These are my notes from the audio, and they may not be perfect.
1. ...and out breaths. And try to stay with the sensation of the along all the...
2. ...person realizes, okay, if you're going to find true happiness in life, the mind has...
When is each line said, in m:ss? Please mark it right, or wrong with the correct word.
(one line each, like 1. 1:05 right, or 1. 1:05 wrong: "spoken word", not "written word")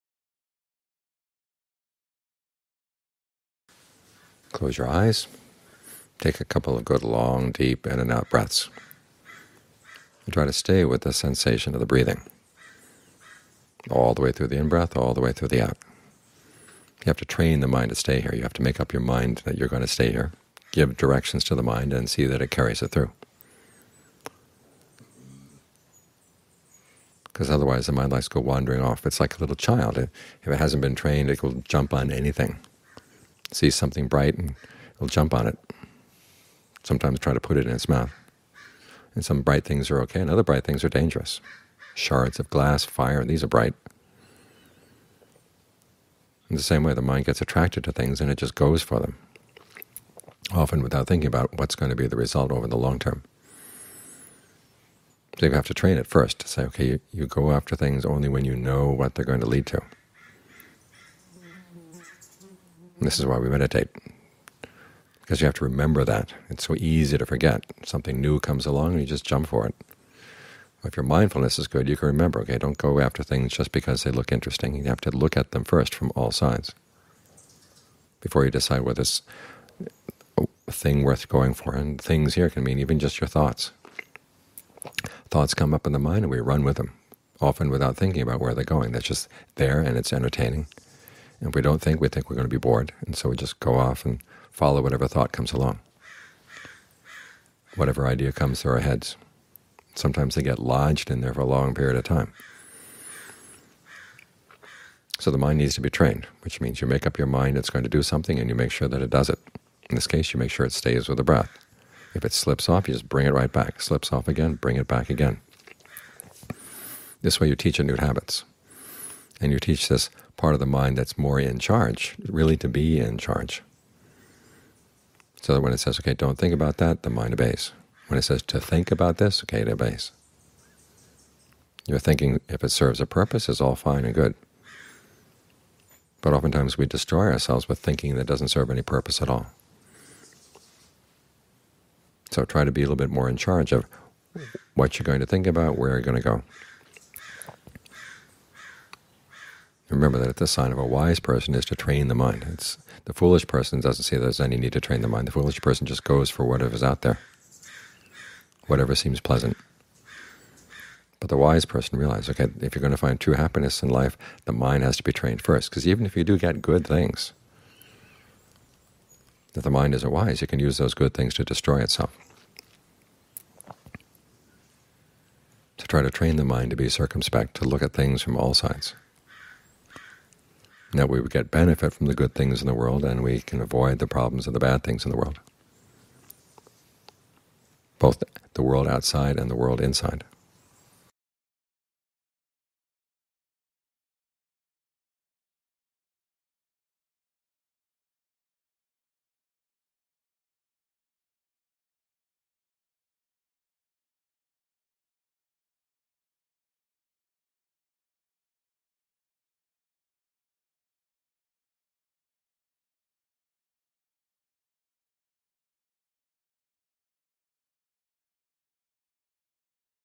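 1. 0:07 wrong: "breathing", not "along"
2. 2:41 right.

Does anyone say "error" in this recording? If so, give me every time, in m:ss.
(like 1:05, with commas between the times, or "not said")
not said.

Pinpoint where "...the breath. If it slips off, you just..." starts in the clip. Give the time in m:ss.
1:51.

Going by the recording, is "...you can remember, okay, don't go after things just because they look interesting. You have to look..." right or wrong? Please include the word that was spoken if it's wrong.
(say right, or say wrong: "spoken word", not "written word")
right.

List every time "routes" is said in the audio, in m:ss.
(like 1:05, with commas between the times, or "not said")
not said.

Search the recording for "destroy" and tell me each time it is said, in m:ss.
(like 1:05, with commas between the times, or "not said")
2:16, 2:51.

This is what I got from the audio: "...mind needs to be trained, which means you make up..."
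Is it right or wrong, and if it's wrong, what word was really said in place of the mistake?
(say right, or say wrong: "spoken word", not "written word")
right.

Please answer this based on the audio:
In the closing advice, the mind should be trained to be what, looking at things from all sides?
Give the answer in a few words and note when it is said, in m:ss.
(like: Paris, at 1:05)
circumspect, at 2:56.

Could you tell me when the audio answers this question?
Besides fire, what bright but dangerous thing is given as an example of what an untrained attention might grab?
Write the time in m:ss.
0:41.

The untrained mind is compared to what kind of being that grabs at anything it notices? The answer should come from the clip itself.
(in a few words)
a little child.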